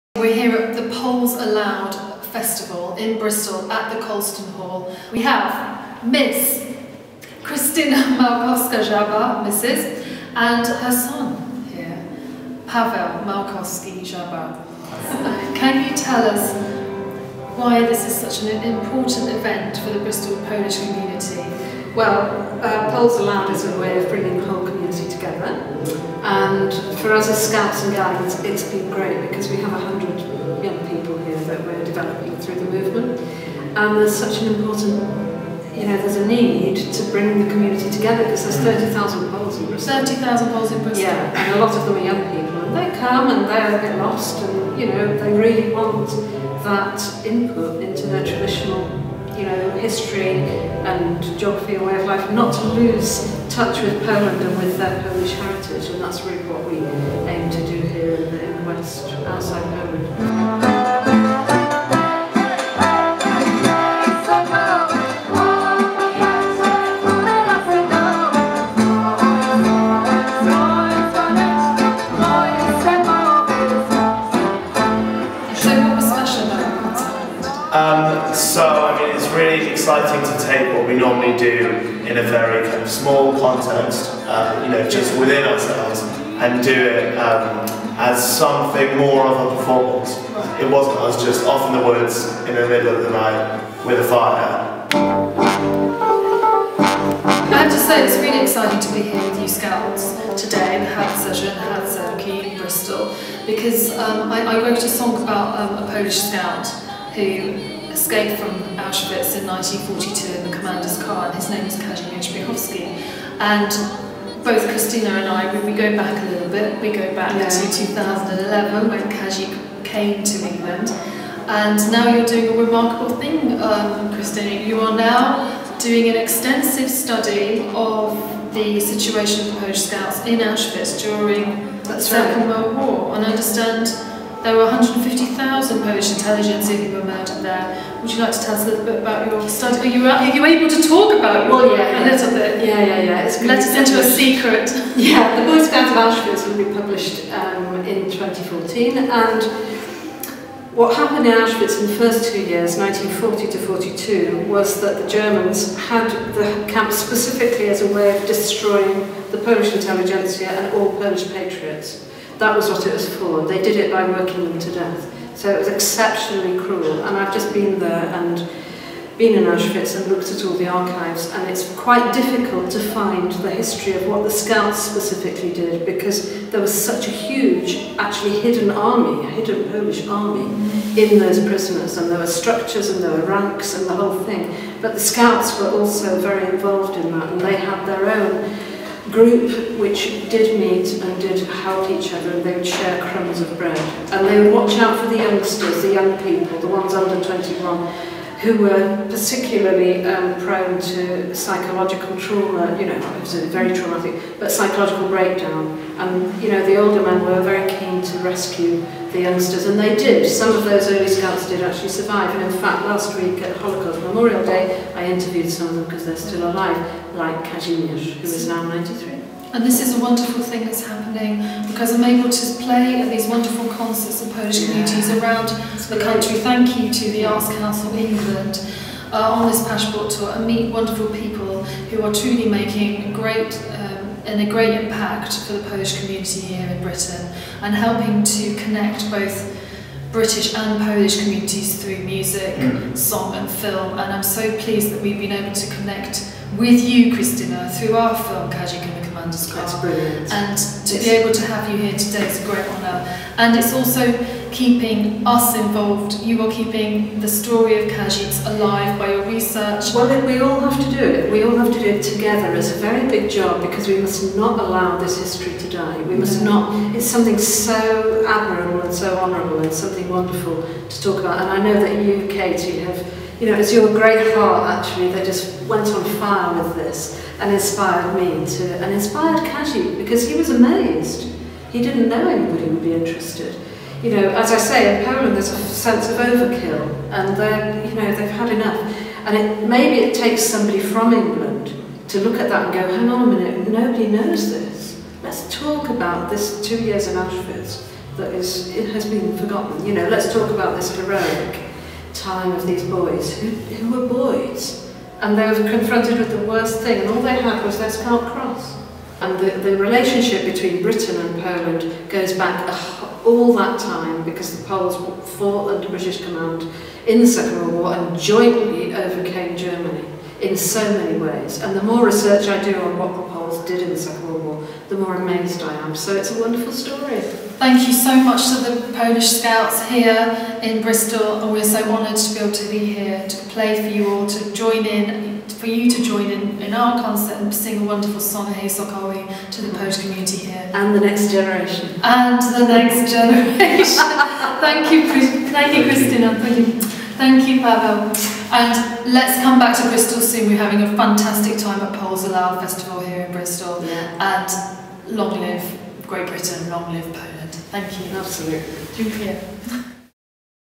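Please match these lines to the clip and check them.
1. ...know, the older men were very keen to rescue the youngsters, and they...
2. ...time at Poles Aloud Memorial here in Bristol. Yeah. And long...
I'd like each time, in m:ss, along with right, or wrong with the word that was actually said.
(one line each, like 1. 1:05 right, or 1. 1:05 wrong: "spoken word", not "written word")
1. 3:26 right
2. 5:51 wrong: "Festival", not "Memorial".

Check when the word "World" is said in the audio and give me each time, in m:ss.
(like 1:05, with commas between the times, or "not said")
2:12, 5:17, 5:24.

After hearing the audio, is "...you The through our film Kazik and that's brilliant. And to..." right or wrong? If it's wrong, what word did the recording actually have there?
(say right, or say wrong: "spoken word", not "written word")
wrong: "Christina", not "The".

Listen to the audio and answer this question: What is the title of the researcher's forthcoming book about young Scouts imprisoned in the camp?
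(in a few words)
The Boy Scouts of Auschwitz.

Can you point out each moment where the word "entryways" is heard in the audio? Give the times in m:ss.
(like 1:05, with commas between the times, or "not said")
not said.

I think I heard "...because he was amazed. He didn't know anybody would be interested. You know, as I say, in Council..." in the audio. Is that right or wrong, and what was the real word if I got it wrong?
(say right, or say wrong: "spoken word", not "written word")
wrong: "Poland", not "Council".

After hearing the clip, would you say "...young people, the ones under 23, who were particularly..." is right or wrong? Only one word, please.
wrong.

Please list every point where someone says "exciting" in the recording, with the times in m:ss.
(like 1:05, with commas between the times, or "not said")
1:19, 1:38.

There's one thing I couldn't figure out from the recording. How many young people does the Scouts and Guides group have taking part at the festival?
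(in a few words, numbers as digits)
100.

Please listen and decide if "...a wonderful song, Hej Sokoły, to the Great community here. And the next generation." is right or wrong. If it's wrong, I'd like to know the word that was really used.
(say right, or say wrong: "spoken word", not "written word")
wrong: "Polish", not "Great".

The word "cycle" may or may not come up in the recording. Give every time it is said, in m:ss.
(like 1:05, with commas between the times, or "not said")
not said.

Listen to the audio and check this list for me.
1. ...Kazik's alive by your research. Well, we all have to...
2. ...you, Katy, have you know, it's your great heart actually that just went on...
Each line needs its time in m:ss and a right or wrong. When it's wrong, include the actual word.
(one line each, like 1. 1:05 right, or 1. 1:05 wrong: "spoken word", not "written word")
1. 4:17 right
2. 4:32 right.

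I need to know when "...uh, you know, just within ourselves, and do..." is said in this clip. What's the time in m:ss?
1:24.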